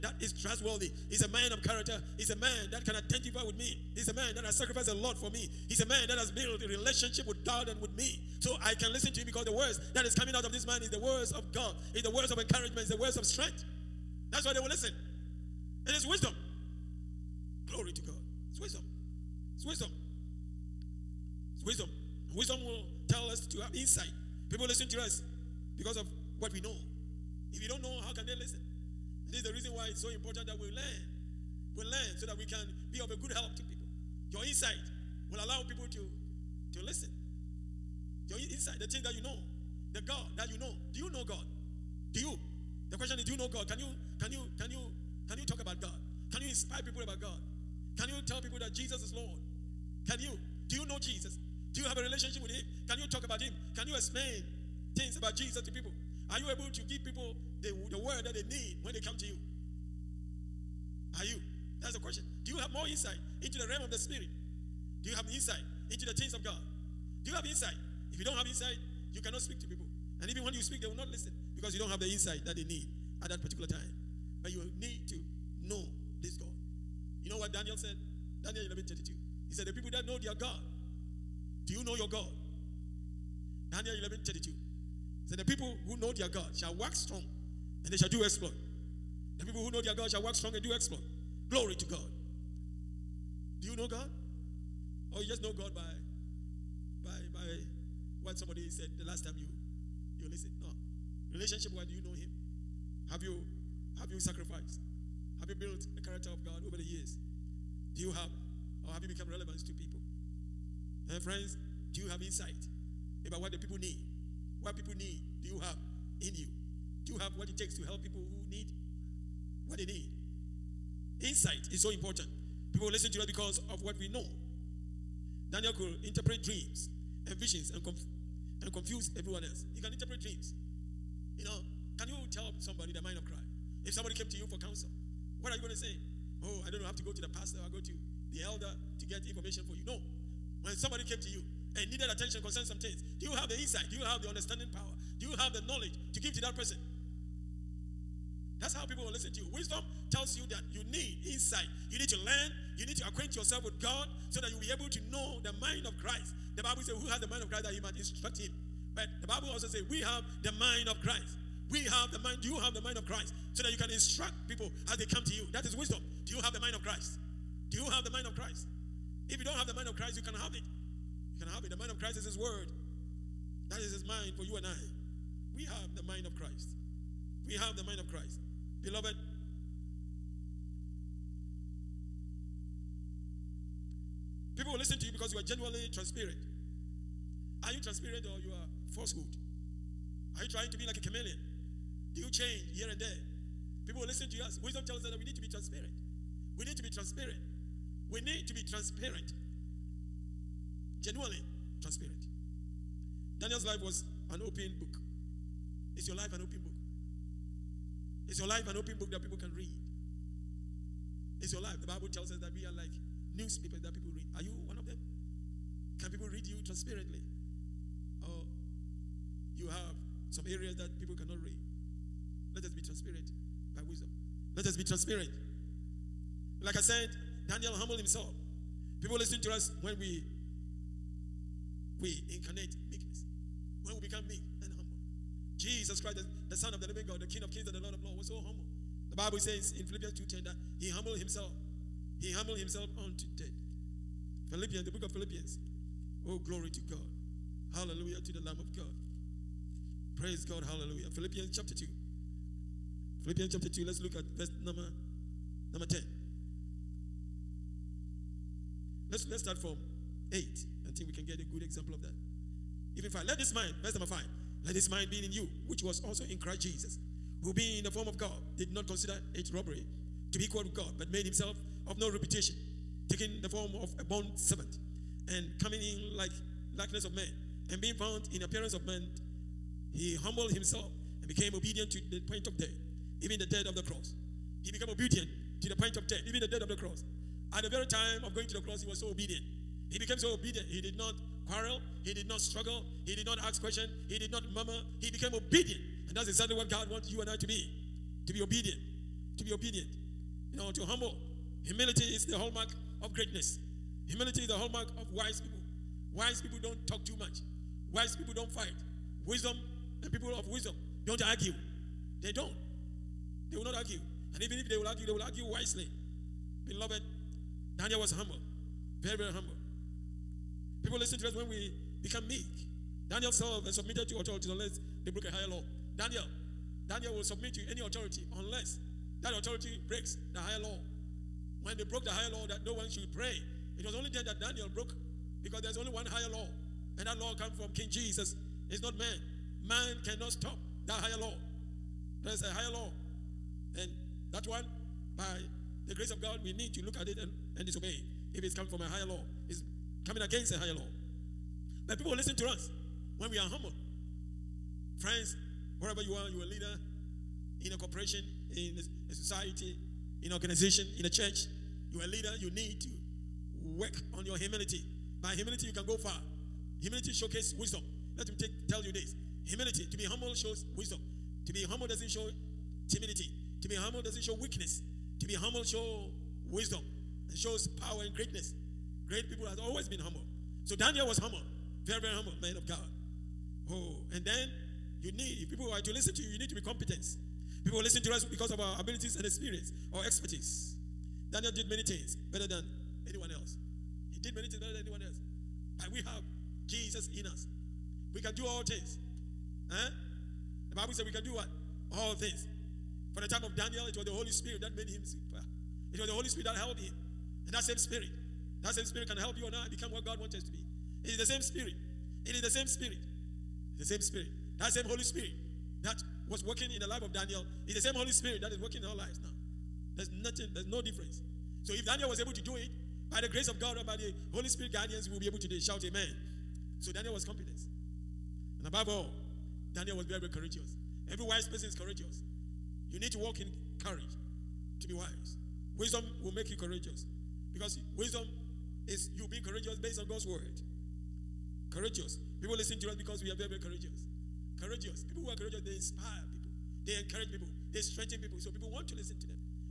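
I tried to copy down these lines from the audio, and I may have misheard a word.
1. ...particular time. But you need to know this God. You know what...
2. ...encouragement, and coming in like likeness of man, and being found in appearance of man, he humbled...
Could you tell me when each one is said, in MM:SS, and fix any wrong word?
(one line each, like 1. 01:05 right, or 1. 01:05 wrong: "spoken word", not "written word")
1. 01:13 right
2. 04:34 wrong: "servant", not "encouragement".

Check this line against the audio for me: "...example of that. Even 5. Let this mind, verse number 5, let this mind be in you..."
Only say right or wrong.
right.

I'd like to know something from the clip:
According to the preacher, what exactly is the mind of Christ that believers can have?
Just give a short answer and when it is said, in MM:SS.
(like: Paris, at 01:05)
His Word, at 02:52.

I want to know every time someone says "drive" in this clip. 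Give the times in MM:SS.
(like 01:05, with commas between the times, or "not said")
not said.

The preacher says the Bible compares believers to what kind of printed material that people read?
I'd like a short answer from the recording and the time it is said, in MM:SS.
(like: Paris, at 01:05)
newspapers, at 03:33.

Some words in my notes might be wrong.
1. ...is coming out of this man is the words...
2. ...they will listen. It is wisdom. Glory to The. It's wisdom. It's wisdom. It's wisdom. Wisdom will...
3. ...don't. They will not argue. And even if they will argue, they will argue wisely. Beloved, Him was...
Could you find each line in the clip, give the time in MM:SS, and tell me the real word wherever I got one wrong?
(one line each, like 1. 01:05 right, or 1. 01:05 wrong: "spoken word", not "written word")
1. 00:10 right
2. 00:14 wrong: "God", not "The"
3. 05:12 wrong: "Daniel", not "Him".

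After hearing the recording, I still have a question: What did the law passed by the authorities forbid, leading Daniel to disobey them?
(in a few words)
that no one should pray.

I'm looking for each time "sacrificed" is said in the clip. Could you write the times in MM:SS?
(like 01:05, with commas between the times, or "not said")
00:04, 01:44.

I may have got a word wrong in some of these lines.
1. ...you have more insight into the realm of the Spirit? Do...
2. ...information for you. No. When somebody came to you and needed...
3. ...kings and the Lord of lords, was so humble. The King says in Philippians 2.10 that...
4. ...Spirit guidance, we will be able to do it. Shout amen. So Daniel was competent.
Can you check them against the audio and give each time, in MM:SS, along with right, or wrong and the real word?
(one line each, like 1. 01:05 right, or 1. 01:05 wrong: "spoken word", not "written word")
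1. 01:02 right
2. 02:19 right
3. 03:57 wrong: "Bible", not "King"
4. 07:04 right.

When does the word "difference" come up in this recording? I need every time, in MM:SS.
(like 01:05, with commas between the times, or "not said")
07:00.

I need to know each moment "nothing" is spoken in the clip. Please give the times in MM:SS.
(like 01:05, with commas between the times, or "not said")
07:00.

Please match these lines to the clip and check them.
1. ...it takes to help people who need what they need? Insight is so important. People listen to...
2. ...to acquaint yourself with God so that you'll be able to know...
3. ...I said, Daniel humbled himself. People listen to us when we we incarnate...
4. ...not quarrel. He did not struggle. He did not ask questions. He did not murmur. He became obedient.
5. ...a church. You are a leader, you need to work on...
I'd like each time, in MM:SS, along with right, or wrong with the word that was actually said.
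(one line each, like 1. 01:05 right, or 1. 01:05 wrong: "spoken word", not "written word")
1. 01:57 right
2. 02:32 right
3. 03:46 right
4. 04:50 right
5. 06:01 right.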